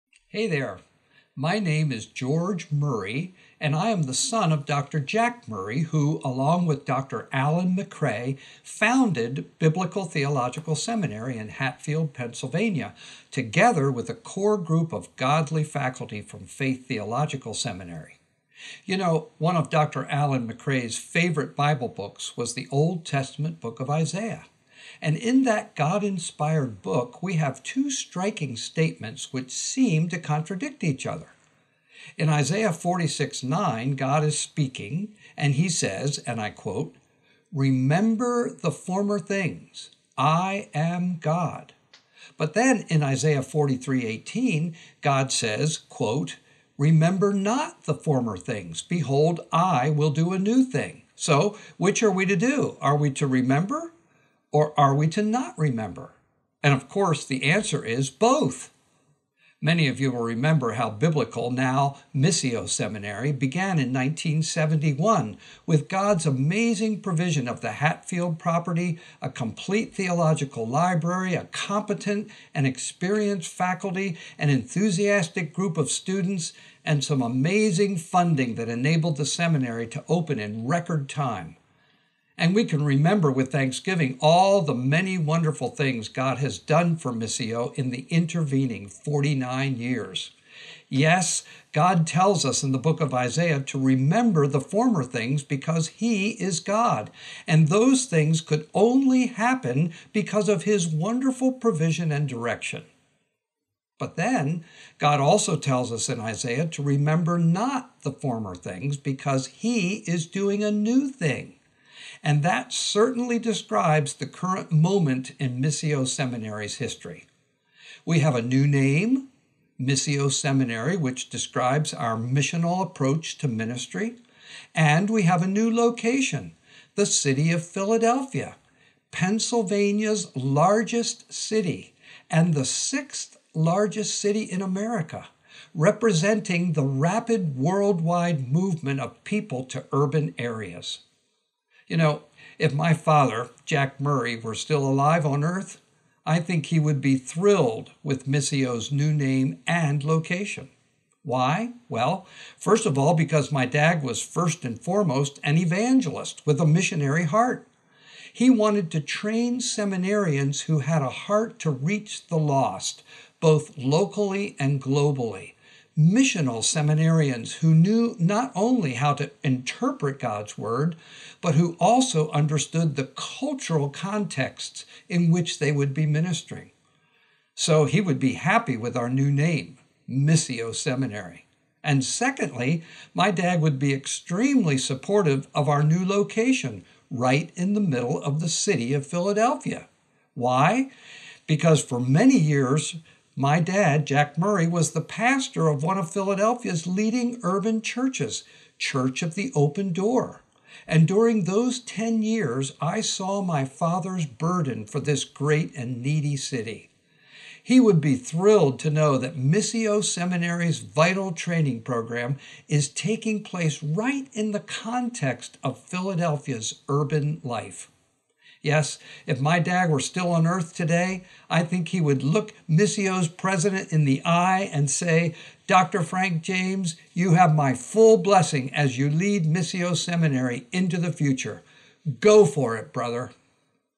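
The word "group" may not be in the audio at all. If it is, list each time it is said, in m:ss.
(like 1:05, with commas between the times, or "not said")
0:14, 1:15.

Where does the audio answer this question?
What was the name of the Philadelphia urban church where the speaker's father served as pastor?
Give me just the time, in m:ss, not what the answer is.
3:18.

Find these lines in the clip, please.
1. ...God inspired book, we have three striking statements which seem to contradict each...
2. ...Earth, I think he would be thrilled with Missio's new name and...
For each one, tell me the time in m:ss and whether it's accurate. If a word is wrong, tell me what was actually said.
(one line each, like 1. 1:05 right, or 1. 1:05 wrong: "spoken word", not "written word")
1. 0:25 wrong: "two", not "three"
2. 2:25 right.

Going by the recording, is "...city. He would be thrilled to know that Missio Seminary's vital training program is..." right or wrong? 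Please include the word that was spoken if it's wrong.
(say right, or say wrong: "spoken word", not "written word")
right.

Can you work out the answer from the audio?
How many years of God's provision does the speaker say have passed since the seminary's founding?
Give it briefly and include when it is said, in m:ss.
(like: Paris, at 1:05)
49, at 1:28.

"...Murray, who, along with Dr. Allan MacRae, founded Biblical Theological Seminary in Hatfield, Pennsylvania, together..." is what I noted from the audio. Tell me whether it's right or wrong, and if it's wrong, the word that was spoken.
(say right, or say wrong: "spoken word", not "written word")
right.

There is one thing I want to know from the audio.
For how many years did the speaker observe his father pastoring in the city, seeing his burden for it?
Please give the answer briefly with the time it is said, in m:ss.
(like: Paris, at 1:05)
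10, at 3:21.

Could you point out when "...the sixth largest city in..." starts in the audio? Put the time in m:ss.
2:12.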